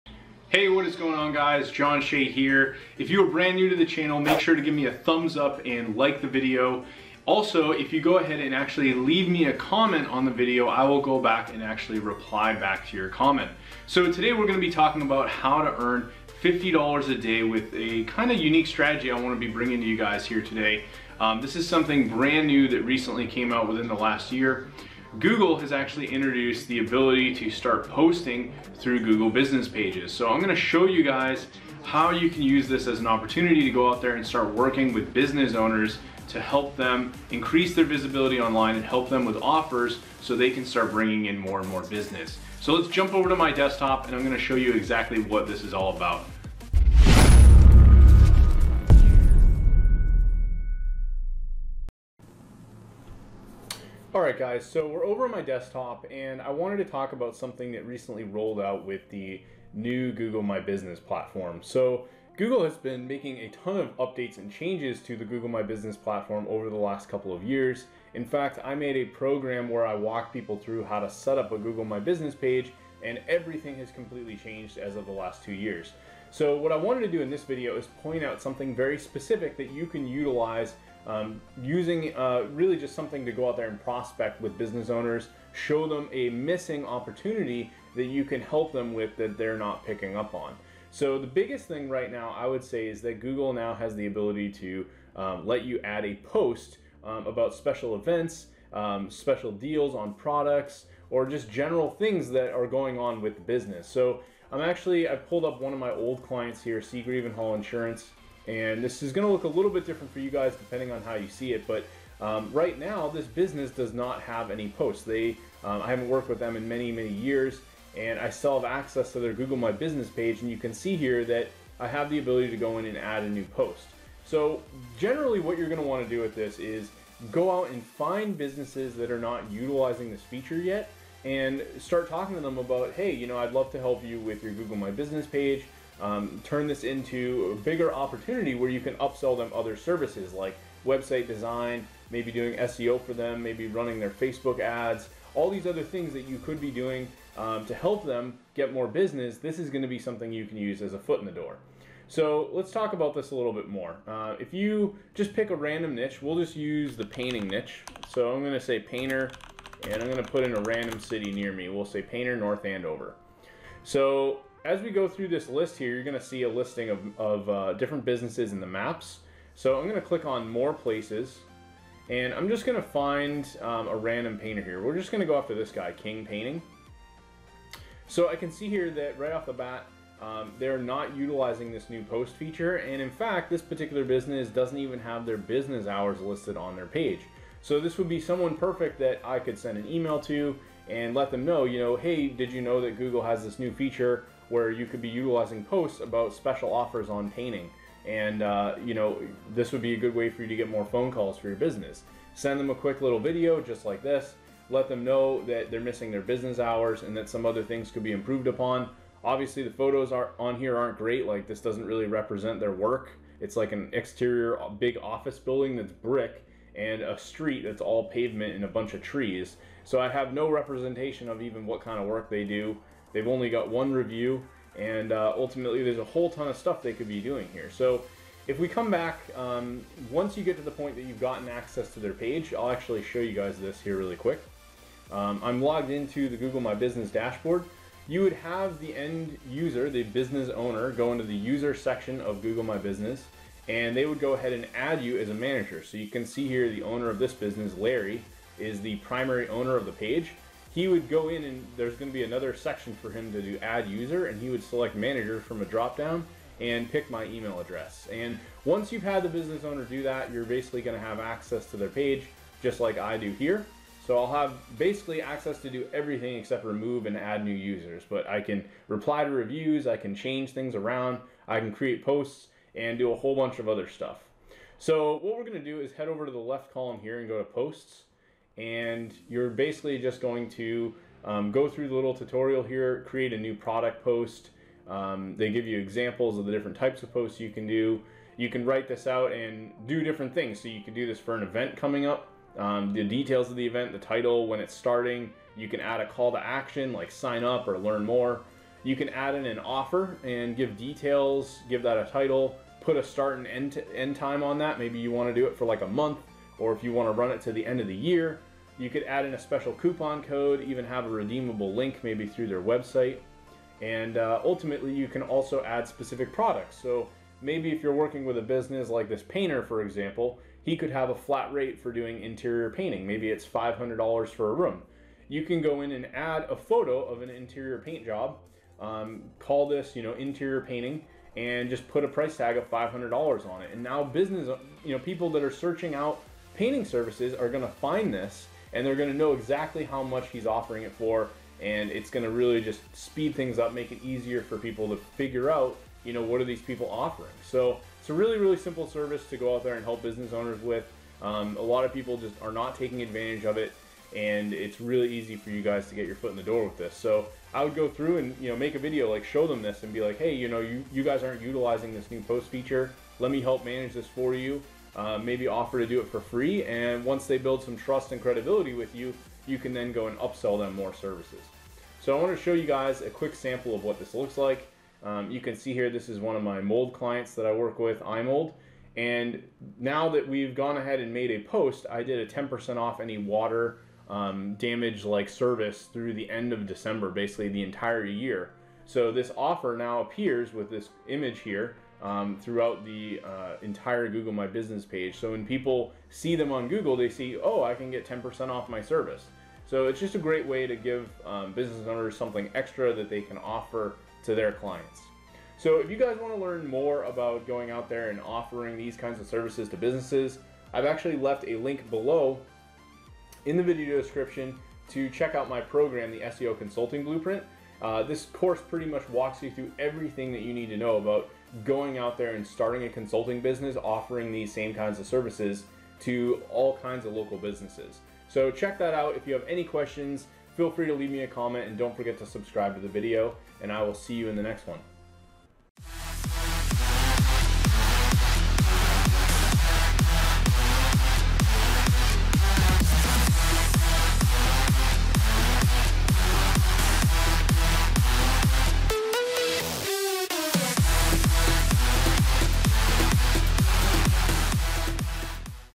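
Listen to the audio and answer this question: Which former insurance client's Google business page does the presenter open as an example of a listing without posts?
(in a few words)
Seagrave and Hall Insurance.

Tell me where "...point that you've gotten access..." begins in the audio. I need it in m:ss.
3:50.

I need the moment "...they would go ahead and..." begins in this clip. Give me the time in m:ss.
4:03.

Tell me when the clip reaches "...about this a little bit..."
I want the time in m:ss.
2:32.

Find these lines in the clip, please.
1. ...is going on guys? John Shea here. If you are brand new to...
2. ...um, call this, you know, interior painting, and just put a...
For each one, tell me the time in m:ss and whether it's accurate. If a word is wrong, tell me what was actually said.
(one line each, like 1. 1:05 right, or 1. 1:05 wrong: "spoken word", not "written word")
1. 0:00 right
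2. 5:28 right.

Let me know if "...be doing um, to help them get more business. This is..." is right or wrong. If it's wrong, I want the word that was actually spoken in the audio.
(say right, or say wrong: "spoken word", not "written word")
right.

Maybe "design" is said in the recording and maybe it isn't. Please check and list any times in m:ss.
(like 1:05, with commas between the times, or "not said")
2:21.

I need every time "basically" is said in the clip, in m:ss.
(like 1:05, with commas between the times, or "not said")
4:20, 4:24, 4:39, 6:27.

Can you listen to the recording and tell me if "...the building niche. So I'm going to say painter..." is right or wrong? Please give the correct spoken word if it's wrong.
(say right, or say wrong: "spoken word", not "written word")
wrong: "painting", not "building".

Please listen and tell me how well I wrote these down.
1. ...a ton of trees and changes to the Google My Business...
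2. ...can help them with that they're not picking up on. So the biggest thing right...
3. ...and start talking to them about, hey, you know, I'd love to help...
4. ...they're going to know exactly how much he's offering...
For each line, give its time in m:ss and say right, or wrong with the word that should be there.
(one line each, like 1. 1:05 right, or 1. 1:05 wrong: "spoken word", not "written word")
1. 1:03 wrong: "updates", not "trees"
2. 1:28 right
3. 2:11 right
4. 5:38 right.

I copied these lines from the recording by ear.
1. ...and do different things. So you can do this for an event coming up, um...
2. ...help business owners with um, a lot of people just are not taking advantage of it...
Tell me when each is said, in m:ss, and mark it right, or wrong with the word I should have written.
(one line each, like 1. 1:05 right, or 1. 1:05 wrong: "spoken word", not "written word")
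1. 4:49 right
2. 5:49 right.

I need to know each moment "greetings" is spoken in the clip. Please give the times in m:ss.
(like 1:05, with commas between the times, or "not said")
not said.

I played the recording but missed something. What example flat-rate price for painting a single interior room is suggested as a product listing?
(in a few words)
$500.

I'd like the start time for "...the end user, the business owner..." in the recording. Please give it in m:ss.
3:58.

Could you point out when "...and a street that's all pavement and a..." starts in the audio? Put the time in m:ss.
3:36.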